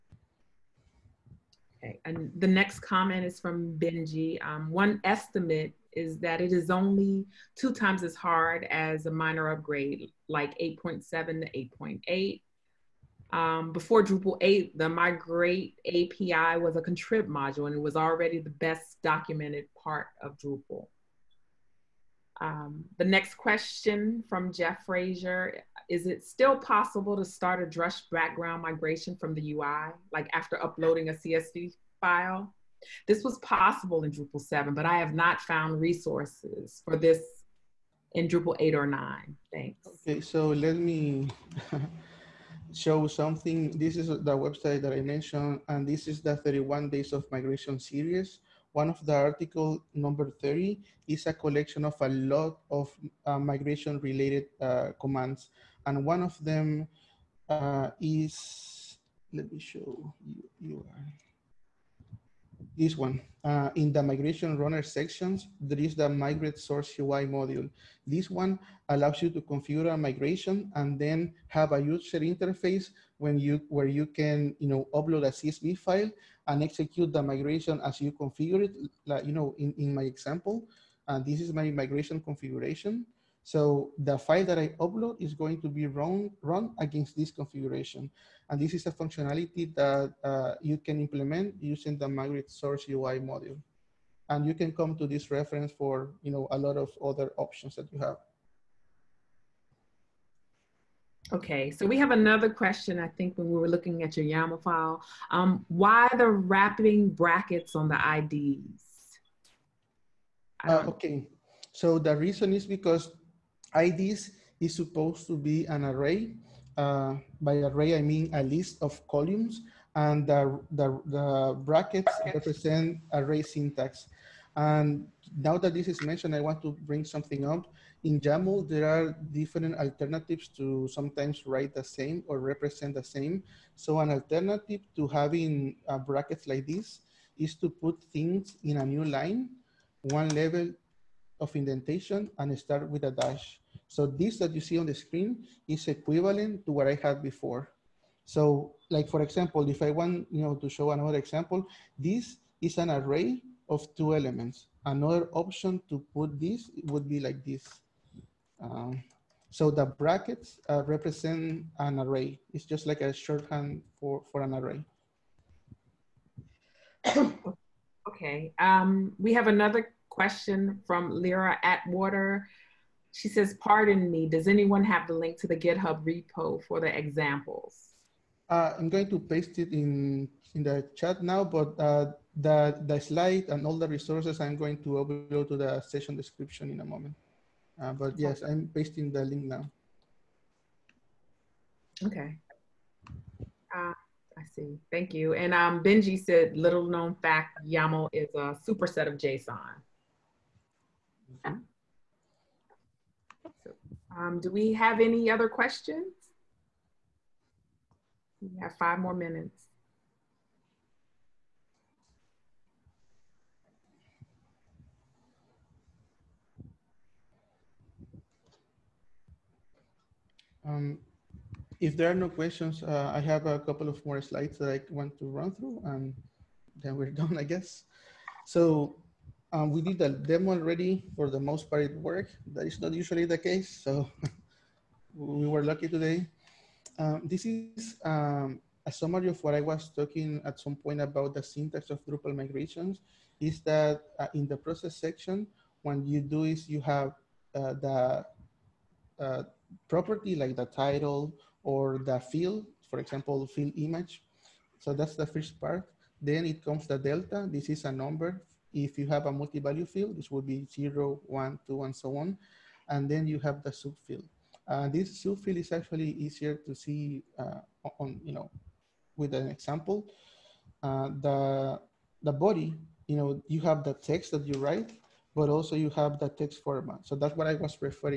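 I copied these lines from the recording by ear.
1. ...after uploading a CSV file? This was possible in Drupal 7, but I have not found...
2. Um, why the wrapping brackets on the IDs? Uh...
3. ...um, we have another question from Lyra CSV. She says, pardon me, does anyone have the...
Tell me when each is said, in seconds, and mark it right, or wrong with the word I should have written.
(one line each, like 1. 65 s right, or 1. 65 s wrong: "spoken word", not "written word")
1. 30 s right
2. 105 s right
3. 168 s wrong: "Atwater", not "CSV".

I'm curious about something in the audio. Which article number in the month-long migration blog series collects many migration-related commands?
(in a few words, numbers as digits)
30.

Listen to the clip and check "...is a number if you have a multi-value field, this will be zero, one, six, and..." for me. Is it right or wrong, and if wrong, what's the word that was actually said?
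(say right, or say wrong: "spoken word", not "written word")
wrong: "two", not "six".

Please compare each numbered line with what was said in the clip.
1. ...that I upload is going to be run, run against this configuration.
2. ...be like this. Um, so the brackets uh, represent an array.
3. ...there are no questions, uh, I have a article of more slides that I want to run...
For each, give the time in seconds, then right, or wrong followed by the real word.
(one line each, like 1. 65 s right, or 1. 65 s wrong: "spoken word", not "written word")
1. 84 s right
2. 157 s right
3. 221 s wrong: "couple", not "article".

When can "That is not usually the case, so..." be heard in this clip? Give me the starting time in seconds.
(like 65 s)
232 s.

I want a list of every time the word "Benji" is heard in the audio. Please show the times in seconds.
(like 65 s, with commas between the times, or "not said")
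3 s, 195 s.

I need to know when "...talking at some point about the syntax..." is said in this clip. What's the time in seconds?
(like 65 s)
239 s.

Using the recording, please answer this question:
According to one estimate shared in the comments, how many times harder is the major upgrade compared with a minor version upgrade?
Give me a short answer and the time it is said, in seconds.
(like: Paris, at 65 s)
2, at 7 s.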